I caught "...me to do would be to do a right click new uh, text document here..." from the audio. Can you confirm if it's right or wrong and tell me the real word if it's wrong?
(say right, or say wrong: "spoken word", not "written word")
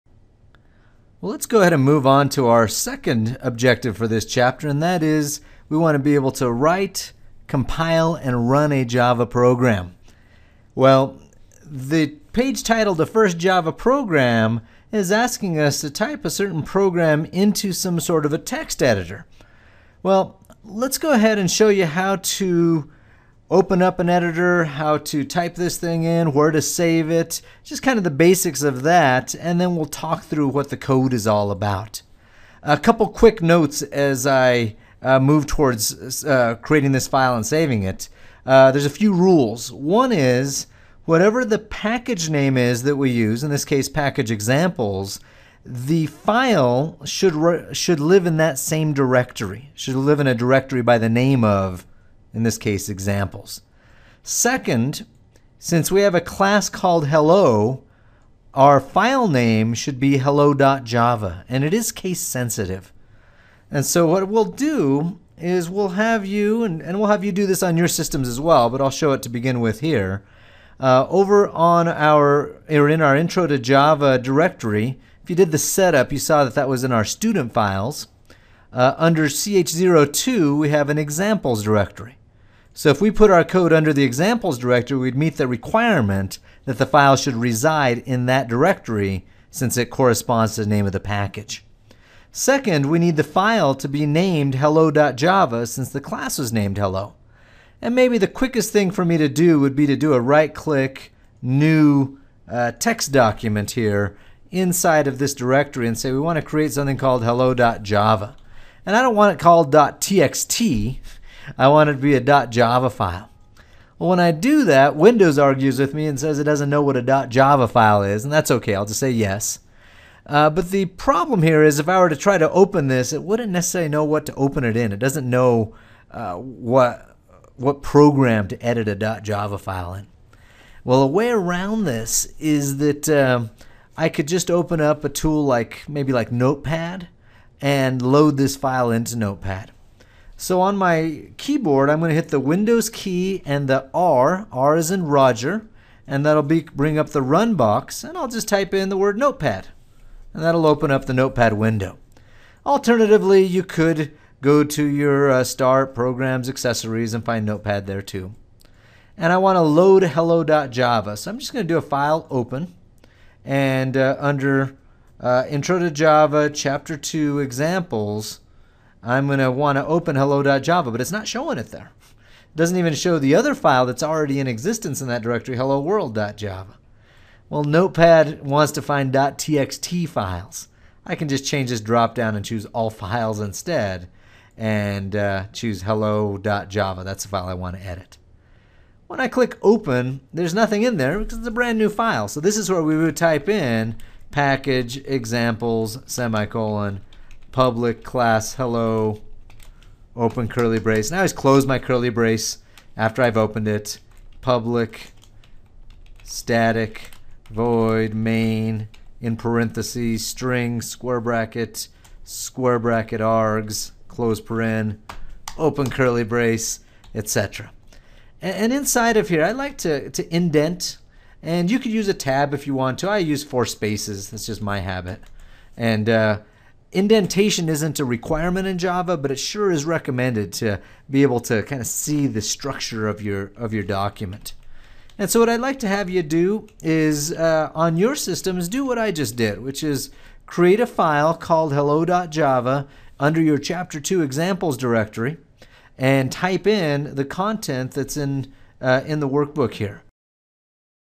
right.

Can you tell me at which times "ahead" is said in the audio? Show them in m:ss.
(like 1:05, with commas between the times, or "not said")
0:01, 0:21.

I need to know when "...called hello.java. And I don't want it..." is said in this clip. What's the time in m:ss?
1:46.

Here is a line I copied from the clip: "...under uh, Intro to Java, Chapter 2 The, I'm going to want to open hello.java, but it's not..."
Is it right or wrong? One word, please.
wrong.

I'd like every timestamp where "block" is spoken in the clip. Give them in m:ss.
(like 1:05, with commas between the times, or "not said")
not said.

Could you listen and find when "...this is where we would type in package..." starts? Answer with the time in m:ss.
3:12.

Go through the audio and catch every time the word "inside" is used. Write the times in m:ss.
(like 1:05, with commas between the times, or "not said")
1:44, 3:38.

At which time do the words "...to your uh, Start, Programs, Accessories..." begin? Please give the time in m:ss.
2:34.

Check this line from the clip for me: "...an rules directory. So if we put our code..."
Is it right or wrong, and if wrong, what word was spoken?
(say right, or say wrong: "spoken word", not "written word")
wrong: "examples", not "rules".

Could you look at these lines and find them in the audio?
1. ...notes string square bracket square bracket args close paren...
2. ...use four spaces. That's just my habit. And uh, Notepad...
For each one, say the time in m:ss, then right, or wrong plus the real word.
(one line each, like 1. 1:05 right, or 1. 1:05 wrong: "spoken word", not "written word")
1. 3:29 wrong: "parentheses", not "notes"
2. 3:43 wrong: "Indentation", not "Notepad".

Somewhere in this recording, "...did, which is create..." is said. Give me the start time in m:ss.
3:59.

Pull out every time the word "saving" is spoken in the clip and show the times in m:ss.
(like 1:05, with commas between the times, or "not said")
0:37.